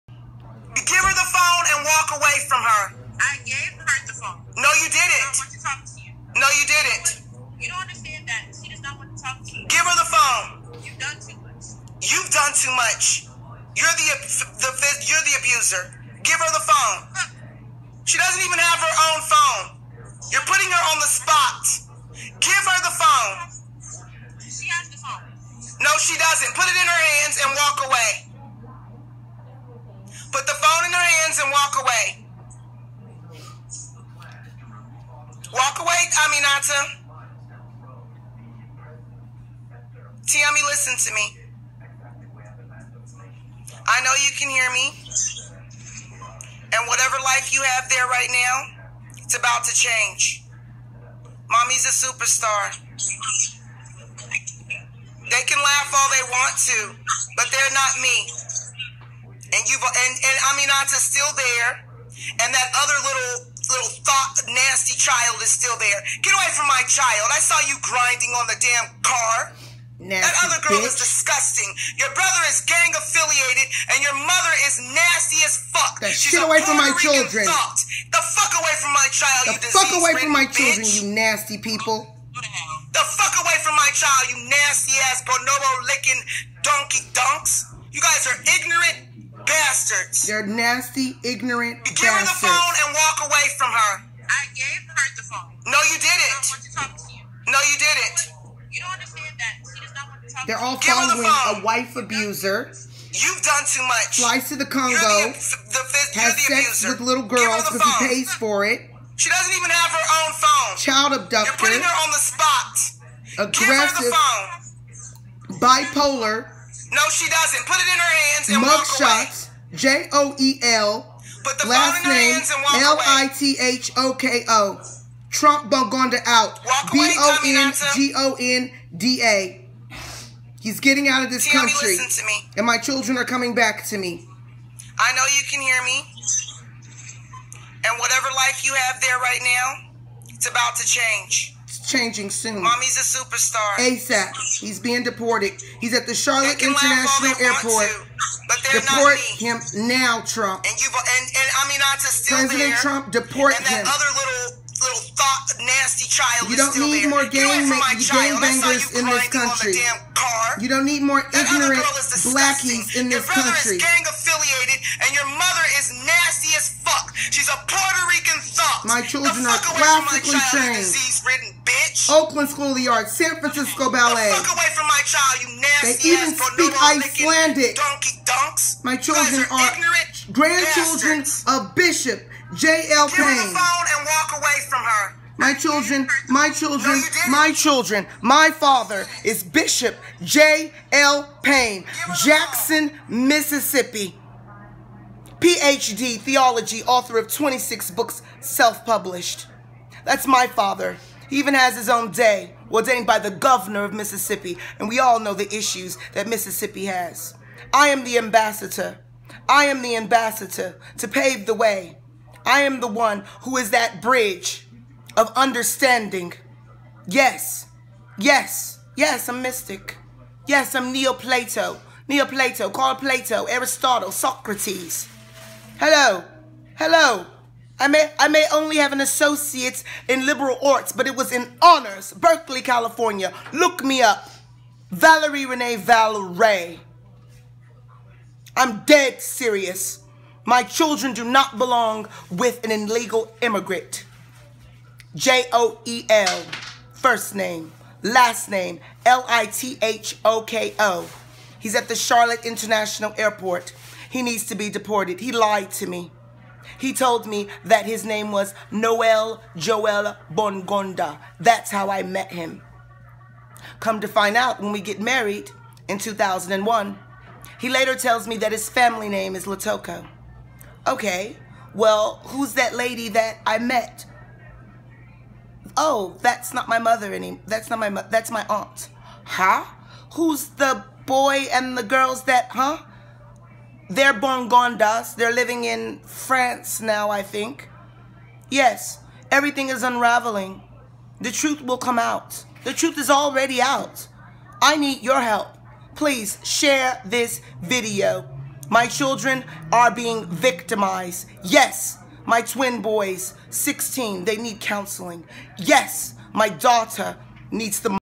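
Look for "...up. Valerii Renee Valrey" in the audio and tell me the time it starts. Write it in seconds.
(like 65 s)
234 s.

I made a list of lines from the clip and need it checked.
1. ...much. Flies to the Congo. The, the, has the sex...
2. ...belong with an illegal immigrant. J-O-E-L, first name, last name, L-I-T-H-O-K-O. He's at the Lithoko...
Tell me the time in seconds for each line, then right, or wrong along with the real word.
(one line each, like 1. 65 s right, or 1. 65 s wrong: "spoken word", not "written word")
1. 103 s right
2. 241 s wrong: "Charlotte", not "Lithoko".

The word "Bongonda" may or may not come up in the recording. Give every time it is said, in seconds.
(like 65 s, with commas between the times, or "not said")
125 s, 260 s, 284 s.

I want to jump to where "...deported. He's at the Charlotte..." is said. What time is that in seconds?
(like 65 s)
145 s.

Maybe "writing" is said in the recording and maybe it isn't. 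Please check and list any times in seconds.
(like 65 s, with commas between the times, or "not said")
not said.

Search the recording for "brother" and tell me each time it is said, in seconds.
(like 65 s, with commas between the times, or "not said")
72 s, 163 s.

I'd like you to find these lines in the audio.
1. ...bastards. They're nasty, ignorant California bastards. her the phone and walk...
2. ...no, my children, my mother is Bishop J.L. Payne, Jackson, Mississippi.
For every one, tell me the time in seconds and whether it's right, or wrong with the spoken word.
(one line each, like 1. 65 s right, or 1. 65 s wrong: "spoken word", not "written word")
1. 89 s wrong: "Give", not "California"
2. 186 s wrong: "father", not "mother".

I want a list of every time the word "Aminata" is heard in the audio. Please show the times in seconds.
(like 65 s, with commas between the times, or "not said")
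36 s, 60 s, 151 s.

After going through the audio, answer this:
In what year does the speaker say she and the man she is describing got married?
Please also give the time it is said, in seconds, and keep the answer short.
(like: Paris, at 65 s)
2001, at 265 s.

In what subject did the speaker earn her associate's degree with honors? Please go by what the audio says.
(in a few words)
Liberal arts.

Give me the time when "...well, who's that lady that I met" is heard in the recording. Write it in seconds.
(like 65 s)
271 s.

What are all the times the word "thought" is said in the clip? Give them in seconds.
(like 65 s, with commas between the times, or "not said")
64 s, 77 s, 155 s.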